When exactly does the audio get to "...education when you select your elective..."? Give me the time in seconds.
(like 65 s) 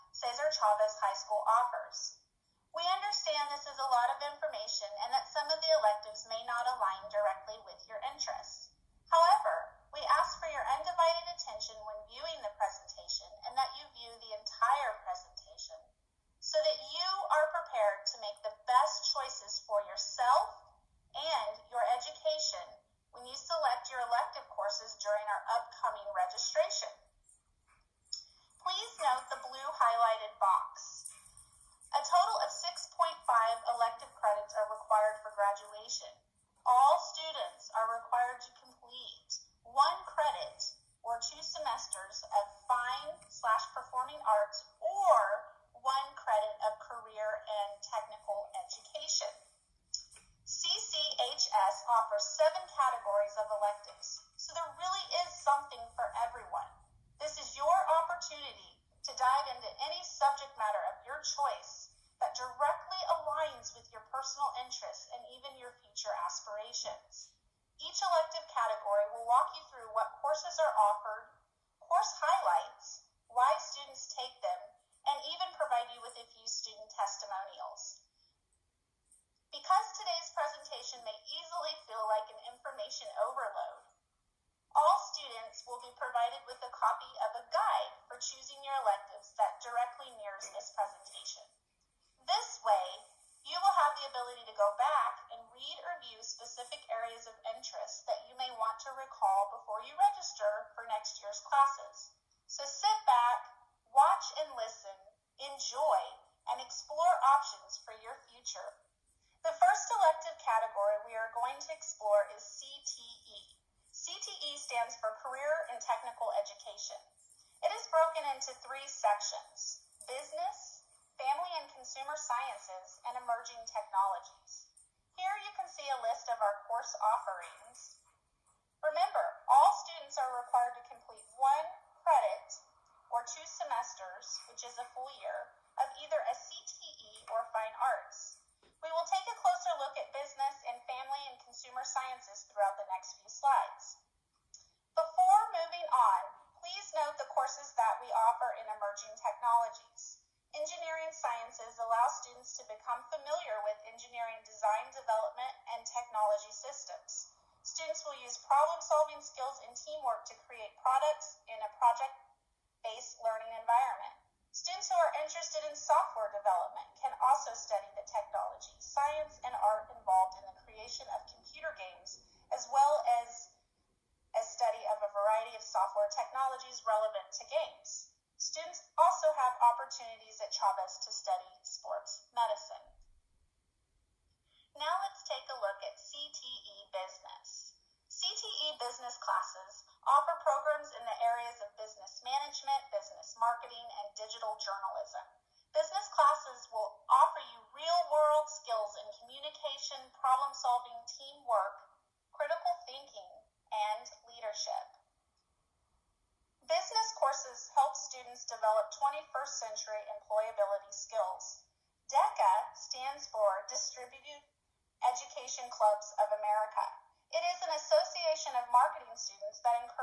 21 s.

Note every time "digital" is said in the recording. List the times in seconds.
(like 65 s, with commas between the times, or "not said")
194 s.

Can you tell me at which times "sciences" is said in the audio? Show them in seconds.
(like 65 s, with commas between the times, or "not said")
122 s, 141 s, 151 s, 168 s.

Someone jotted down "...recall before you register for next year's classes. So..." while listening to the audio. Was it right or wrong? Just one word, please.
right.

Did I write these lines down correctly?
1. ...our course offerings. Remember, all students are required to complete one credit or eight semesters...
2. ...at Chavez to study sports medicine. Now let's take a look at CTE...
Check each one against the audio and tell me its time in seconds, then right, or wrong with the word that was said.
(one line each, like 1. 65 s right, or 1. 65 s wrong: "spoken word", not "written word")
1. 126 s wrong: "two", not "eight"
2. 180 s right.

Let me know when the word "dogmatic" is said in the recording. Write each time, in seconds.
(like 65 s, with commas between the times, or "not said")
not said.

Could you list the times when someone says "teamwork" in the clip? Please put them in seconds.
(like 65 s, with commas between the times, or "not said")
159 s, 201 s.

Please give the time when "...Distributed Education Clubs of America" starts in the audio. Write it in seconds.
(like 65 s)
213 s.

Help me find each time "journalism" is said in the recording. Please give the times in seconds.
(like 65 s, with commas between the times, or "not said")
194 s.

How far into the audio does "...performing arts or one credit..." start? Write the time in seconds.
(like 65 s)
43 s.